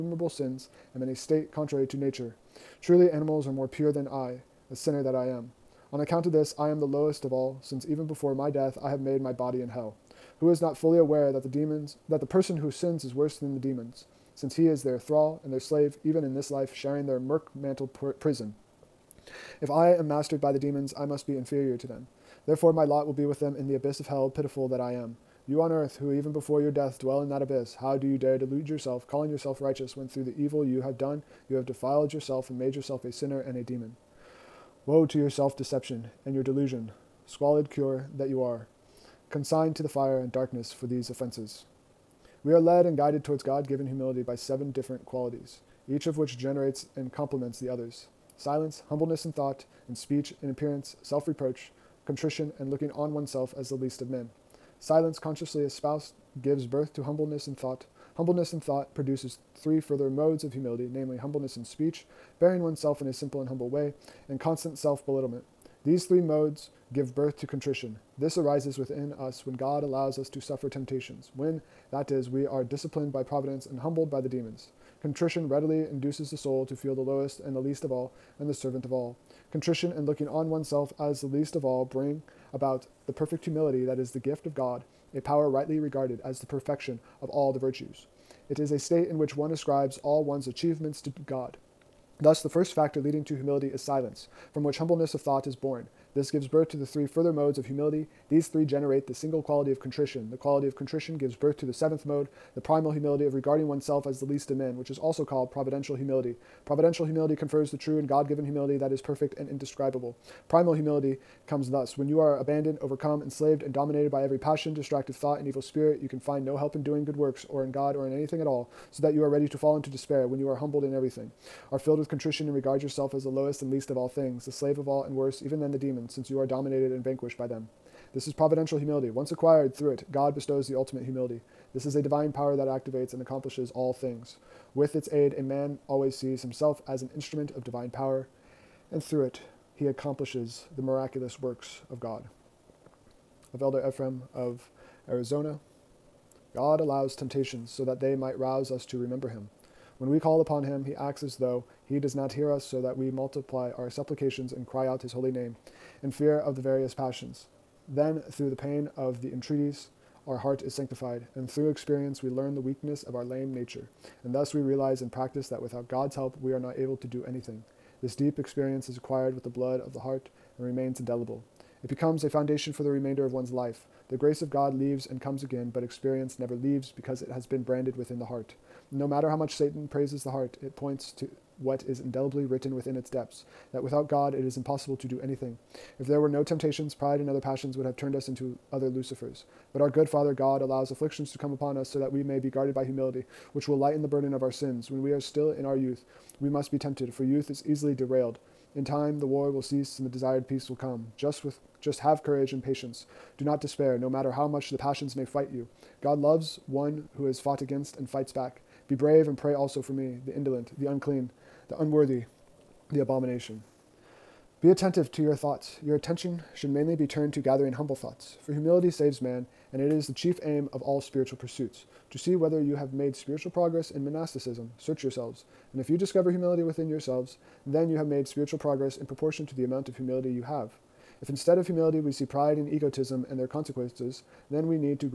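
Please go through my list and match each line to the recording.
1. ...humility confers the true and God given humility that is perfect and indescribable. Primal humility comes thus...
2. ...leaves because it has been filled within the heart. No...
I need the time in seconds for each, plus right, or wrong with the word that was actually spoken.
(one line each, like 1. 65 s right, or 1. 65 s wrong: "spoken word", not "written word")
1. 107 s right
2. 176 s wrong: "branded", not "filled".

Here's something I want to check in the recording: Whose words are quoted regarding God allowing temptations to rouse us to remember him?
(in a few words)
Elder Ephraim of Arizona.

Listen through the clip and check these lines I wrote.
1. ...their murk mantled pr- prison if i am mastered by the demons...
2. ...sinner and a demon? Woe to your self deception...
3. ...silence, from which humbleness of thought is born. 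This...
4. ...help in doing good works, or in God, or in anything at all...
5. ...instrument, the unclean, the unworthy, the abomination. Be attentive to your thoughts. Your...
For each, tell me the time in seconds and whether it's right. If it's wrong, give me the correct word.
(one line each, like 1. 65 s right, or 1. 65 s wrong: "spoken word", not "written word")
1. 17 s right
2. 33 s right
3. 93 s right
4. 116 s right
5. 210 s wrong: "indolent", not "instrument".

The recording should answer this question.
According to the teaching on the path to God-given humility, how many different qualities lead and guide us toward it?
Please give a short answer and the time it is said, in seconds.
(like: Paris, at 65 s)
7, at 44 s.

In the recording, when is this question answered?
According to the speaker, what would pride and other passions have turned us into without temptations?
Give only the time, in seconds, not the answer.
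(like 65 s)
188 s.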